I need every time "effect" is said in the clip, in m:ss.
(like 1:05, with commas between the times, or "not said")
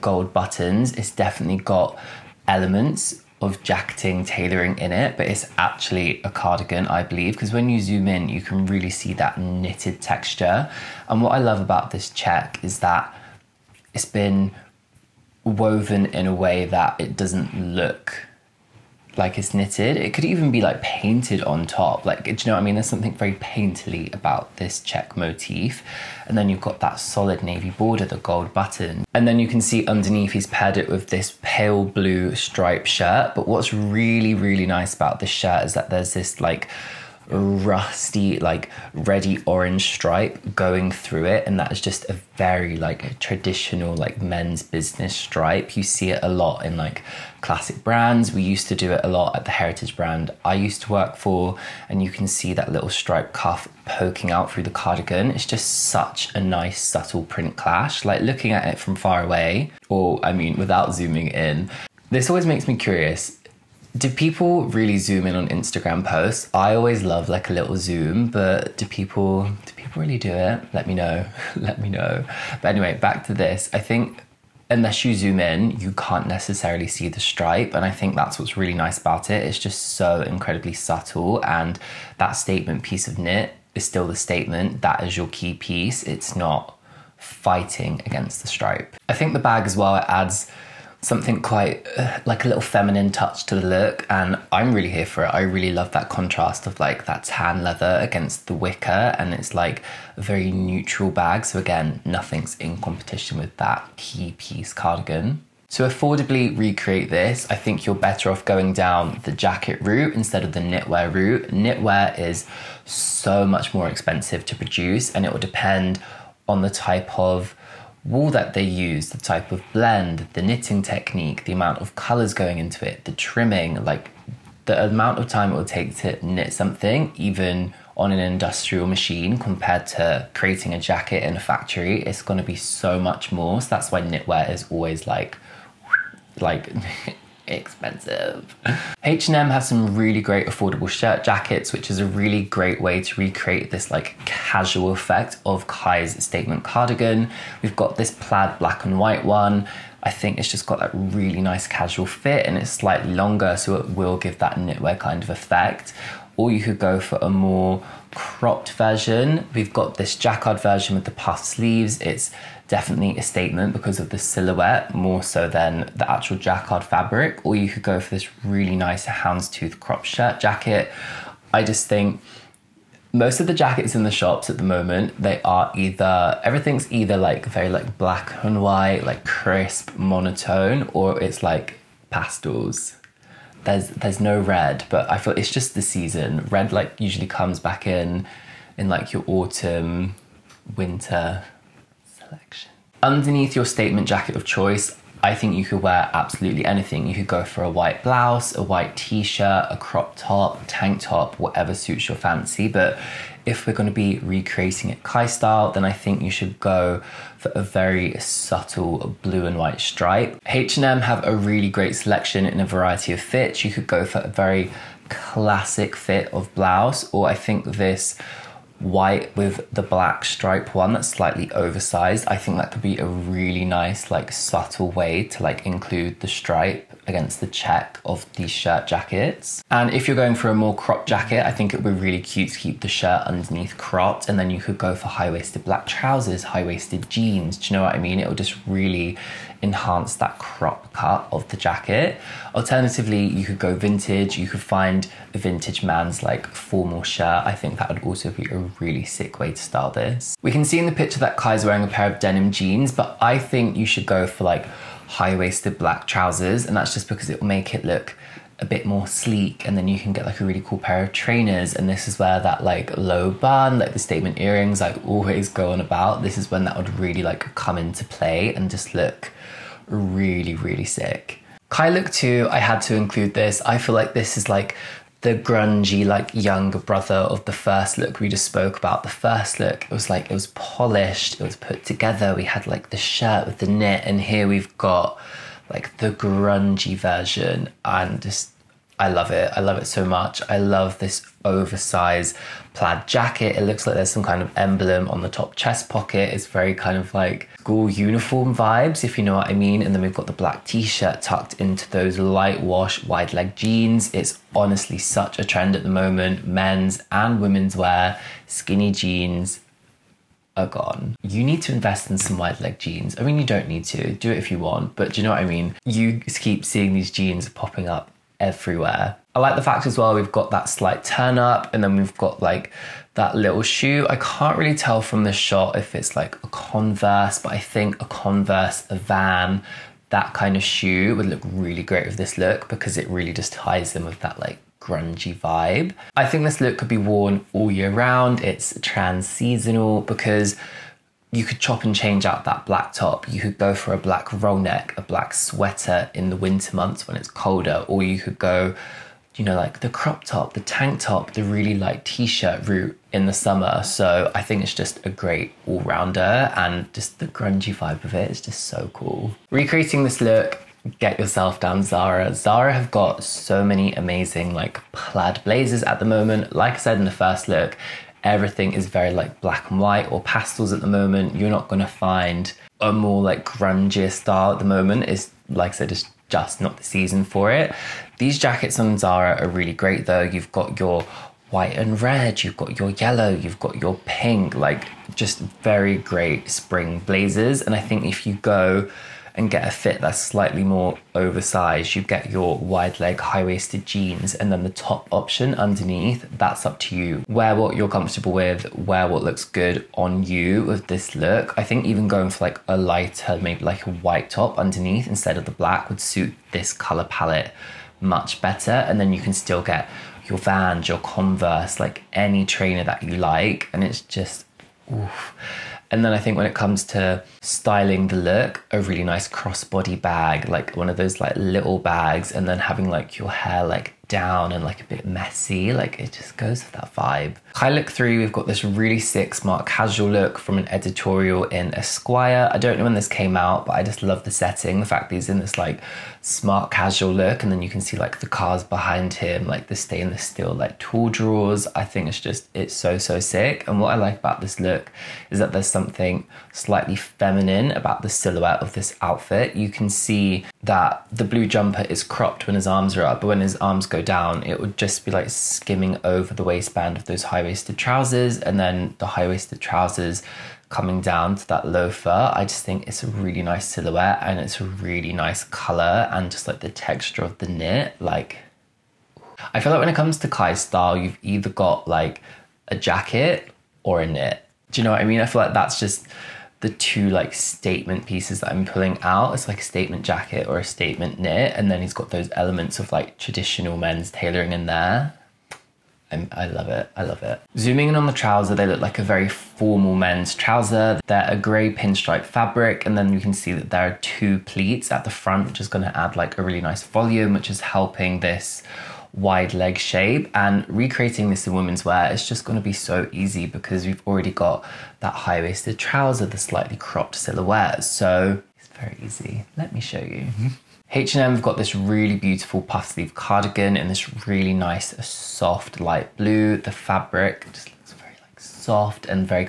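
2:24, 2:35.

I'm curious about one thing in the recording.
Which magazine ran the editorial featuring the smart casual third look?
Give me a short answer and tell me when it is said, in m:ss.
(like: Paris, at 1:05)
Esquire, at 7:11.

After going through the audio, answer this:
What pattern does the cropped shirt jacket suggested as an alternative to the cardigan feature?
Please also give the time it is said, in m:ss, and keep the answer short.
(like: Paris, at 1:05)
Houndstooth, at 2:49.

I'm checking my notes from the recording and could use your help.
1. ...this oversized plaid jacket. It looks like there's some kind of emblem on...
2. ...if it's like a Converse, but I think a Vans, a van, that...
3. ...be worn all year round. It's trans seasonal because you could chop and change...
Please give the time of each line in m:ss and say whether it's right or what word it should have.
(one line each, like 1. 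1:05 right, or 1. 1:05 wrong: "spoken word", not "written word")
1. 4:50 right
2. 5:25 wrong: "Converse", not "Vans"
3. 5:36 right.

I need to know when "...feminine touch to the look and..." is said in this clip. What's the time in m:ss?
1:32.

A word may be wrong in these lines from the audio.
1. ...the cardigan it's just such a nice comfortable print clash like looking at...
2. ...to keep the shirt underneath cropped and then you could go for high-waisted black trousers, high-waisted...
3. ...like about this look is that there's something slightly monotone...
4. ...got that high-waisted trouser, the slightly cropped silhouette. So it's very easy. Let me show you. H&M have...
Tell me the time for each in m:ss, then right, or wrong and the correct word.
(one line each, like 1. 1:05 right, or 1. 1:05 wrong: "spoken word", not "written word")
1. 0:54 wrong: "subtle", not "comfortable"
2. 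3:52 right
3. 7:23 wrong: "feminine", not "monotone"
4. 8:24 right.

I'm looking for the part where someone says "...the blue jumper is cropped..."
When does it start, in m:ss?
7:31.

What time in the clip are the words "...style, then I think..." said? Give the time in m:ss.
3:25.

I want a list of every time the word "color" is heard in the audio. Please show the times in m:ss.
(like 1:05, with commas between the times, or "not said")
2:01, 6:46, 7:45.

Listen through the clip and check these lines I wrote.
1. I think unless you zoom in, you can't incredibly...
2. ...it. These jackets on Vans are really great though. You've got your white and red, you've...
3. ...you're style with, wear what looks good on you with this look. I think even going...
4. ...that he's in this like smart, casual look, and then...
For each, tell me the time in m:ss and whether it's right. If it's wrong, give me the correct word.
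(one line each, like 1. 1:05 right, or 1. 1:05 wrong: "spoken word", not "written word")
1. 1:13 wrong: "necessarily", not "incredibly"
2. 6:17 wrong: "Zara", not "Vans"
3. 6:37 wrong: "comfortable", not "style"
4. 7:15 right.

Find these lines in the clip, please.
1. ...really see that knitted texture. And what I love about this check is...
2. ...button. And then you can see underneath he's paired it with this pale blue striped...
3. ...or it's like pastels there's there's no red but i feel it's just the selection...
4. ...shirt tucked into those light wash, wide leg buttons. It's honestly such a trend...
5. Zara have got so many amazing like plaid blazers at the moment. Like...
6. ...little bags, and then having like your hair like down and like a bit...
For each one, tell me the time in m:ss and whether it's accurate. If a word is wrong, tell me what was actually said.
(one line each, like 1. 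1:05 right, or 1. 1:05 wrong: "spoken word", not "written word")
1. 0:08 right
2. 0:28 right
3. 3:00 wrong: "season", not "selection"
4. 5:00 wrong: "jeans", not "buttons"
5. 6:02 right
6. 7:01 right.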